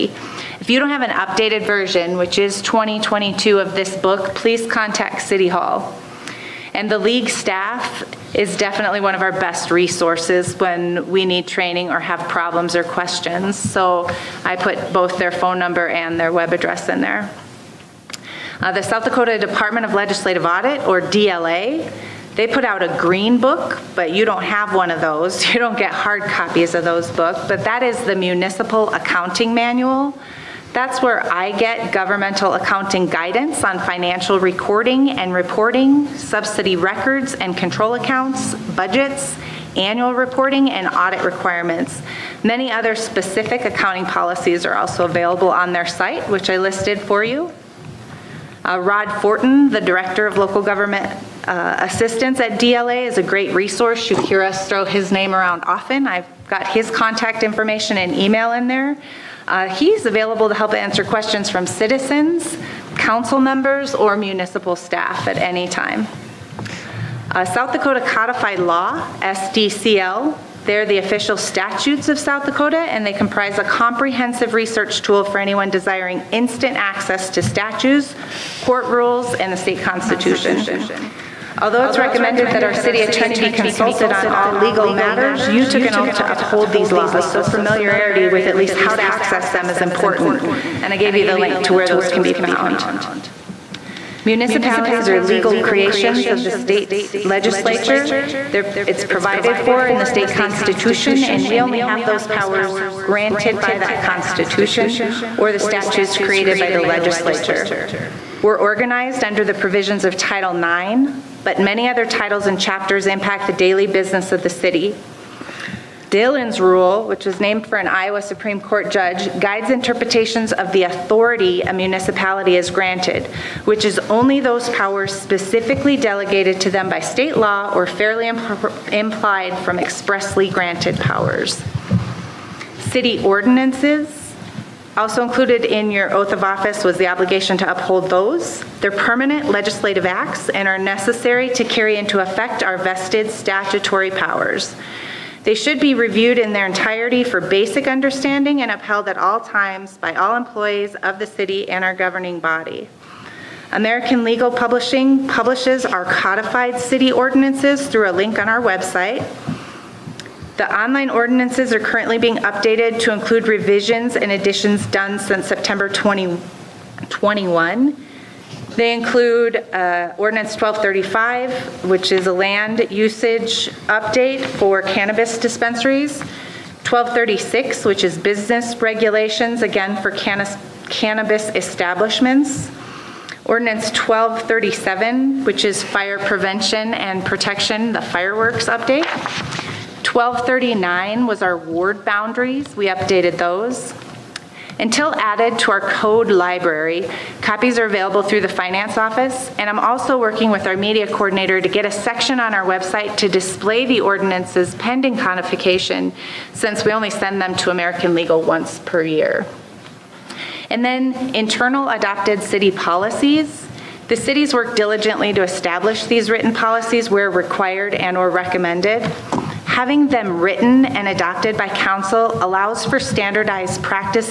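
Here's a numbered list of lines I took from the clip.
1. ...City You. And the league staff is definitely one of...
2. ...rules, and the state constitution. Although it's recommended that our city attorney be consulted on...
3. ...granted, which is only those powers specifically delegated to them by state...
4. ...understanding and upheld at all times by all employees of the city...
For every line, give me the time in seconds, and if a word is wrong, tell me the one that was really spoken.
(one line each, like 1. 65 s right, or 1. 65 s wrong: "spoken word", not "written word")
1. 5 s wrong: "Hall", not "You"
2. 78 s right
3. 122 s right
4. 147 s right.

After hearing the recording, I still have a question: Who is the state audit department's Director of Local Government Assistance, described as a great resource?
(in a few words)
Rod Fortin.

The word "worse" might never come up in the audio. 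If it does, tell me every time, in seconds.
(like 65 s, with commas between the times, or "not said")
not said.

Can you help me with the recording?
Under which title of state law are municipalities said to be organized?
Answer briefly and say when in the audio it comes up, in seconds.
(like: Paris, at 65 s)
Title IX, at 110 s.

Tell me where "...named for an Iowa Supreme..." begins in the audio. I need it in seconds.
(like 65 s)
117 s.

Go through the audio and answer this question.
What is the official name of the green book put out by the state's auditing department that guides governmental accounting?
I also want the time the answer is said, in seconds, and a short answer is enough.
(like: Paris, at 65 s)
Municipal Accounting Manual, at 28 s.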